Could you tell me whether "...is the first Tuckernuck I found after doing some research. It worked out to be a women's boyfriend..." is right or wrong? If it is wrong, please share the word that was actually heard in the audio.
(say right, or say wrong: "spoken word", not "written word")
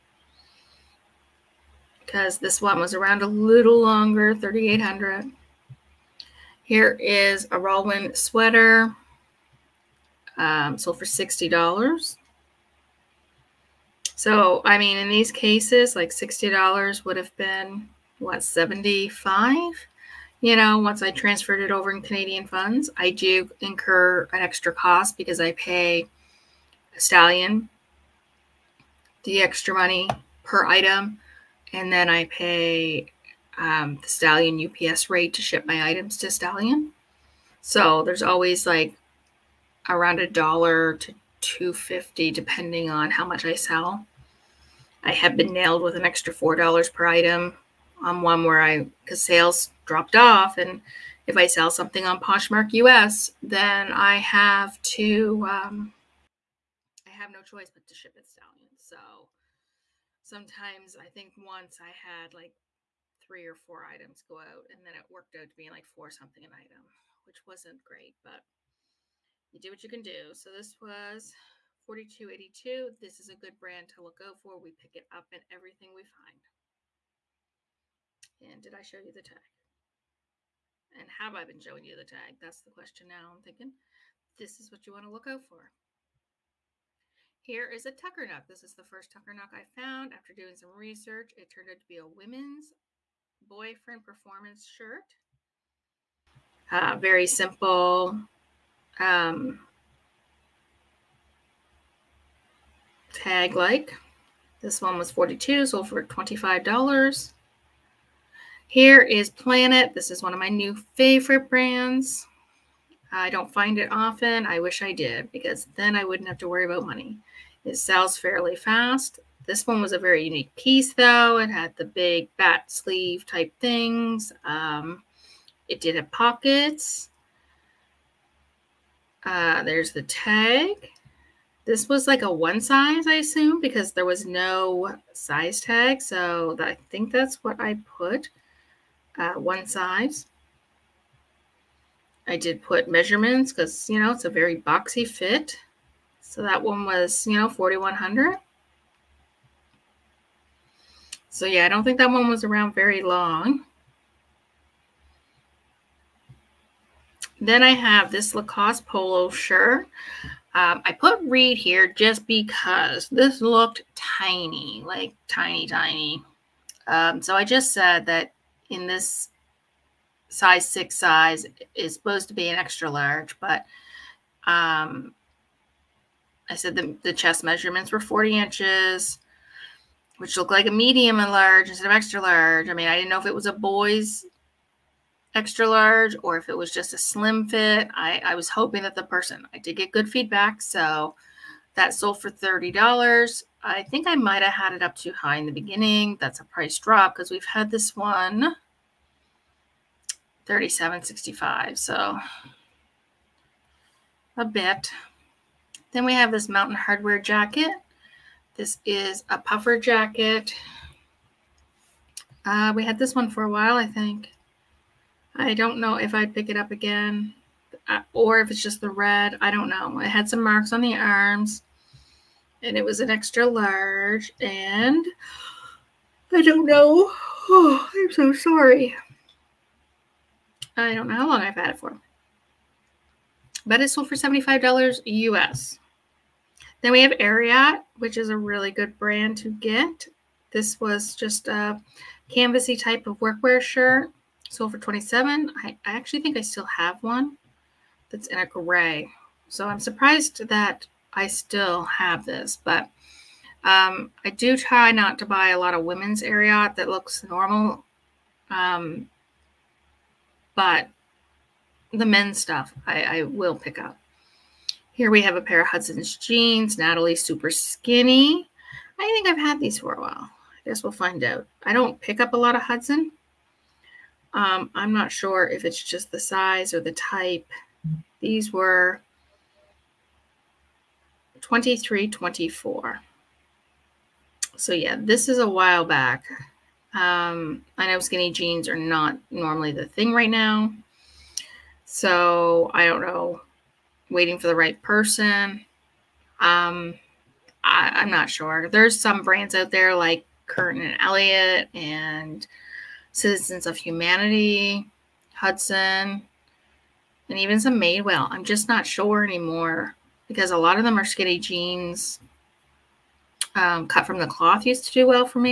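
wrong: "turned", not "worked".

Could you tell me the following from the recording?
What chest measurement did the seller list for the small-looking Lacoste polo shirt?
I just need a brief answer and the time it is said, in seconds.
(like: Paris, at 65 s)
40 inches, at 178 s.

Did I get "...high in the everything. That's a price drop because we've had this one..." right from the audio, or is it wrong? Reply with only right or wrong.
wrong.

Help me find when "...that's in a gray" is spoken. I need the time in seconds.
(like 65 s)
248 s.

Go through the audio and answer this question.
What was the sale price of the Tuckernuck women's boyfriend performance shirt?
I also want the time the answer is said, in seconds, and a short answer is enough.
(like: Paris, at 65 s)
$25, at 105 s.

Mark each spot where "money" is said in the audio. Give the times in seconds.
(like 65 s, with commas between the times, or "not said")
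29 s, 116 s.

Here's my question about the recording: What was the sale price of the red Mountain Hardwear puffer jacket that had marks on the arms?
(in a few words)
$75 US.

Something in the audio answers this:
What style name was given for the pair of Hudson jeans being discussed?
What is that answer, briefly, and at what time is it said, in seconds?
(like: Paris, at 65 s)
Natalie super skinny, at 266 s.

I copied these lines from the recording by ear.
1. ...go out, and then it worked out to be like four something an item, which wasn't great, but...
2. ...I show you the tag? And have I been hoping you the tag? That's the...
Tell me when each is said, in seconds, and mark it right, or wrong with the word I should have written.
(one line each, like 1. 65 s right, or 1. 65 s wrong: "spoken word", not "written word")
1. 64 s right
2. 78 s wrong: "showing", not "hoping".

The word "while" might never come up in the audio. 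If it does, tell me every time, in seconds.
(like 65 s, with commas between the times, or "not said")
213 s, 270 s, 285 s.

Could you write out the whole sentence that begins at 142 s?
I did put measurements because, you know, it's a very boxy fit.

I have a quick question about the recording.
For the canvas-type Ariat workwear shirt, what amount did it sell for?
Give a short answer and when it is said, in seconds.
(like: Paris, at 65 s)
27, at 244 s.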